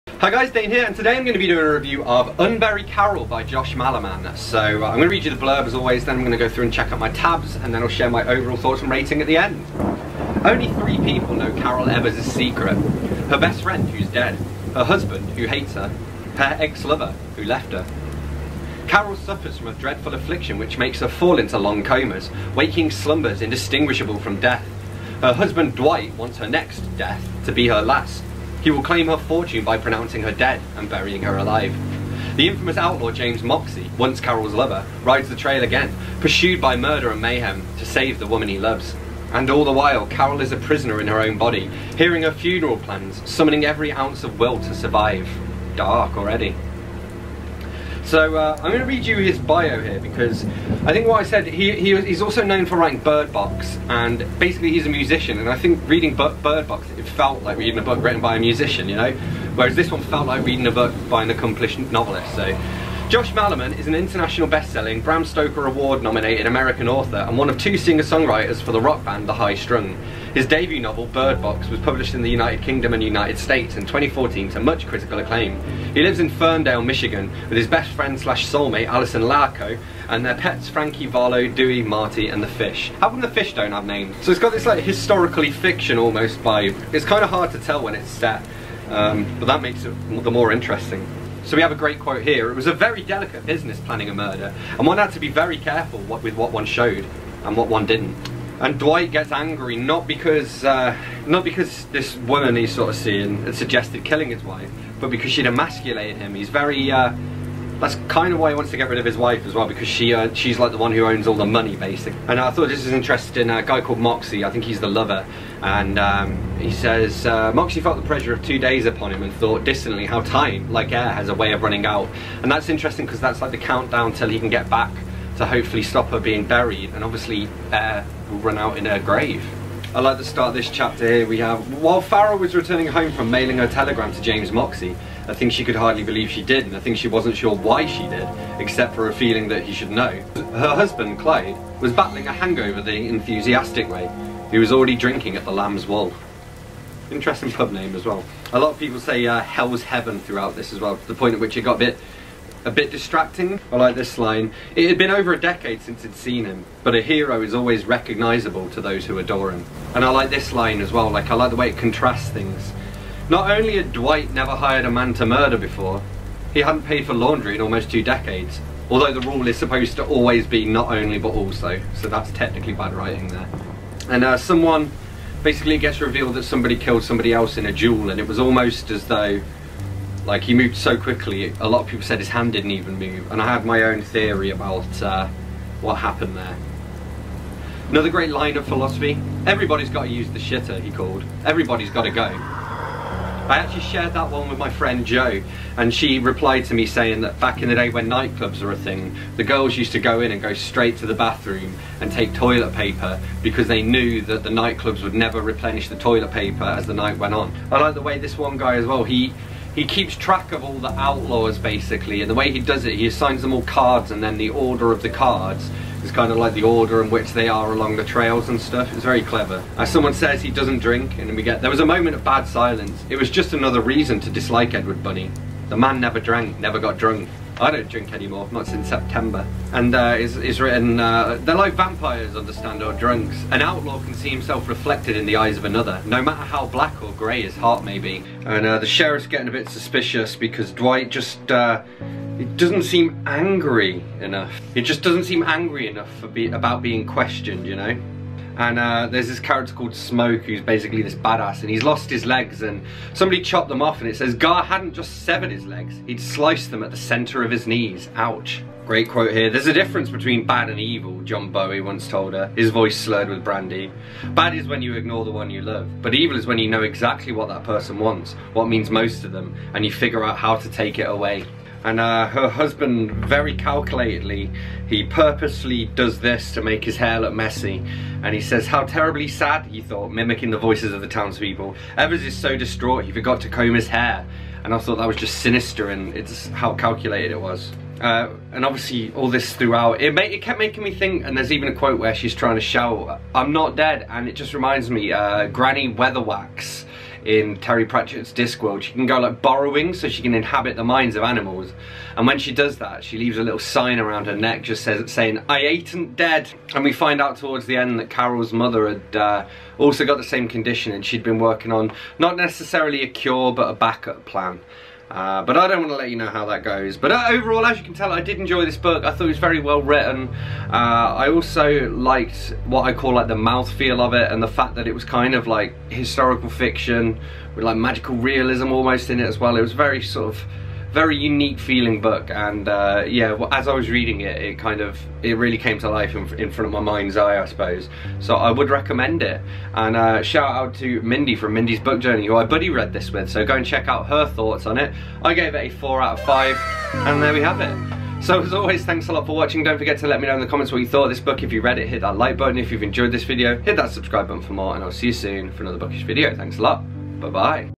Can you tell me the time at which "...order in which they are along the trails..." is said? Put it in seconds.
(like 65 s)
216 s.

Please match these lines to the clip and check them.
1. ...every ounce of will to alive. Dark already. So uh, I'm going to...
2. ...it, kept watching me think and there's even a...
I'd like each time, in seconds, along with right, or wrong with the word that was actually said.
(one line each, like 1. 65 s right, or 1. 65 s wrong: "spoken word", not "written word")
1. 43 s wrong: "survive", not "alive"
2. 290 s wrong: "making", not "watching".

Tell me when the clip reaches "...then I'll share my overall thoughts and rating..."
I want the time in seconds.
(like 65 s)
7 s.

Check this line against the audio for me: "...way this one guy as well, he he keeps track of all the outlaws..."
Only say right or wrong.
right.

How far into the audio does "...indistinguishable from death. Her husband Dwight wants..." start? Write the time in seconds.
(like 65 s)
23 s.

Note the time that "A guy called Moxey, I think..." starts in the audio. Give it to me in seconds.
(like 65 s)
113 s.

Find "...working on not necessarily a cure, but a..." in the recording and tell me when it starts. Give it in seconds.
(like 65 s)
311 s.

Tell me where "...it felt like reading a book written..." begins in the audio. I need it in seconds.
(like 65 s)
56 s.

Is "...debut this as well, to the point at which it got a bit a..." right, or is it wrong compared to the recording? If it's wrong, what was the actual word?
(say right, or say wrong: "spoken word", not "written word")
wrong: "throughout", not "debut".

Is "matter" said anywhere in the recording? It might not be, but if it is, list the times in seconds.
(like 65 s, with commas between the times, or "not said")
236 s.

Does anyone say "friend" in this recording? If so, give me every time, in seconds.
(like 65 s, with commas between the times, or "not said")
13 s, 77 s, 194 s.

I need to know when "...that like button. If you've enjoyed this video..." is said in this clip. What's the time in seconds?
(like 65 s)
352 s.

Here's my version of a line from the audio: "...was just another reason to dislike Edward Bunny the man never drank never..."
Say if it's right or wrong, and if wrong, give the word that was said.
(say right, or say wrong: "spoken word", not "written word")
right.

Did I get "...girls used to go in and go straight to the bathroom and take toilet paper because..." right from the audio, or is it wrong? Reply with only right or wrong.
right.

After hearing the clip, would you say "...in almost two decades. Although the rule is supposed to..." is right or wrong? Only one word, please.
right.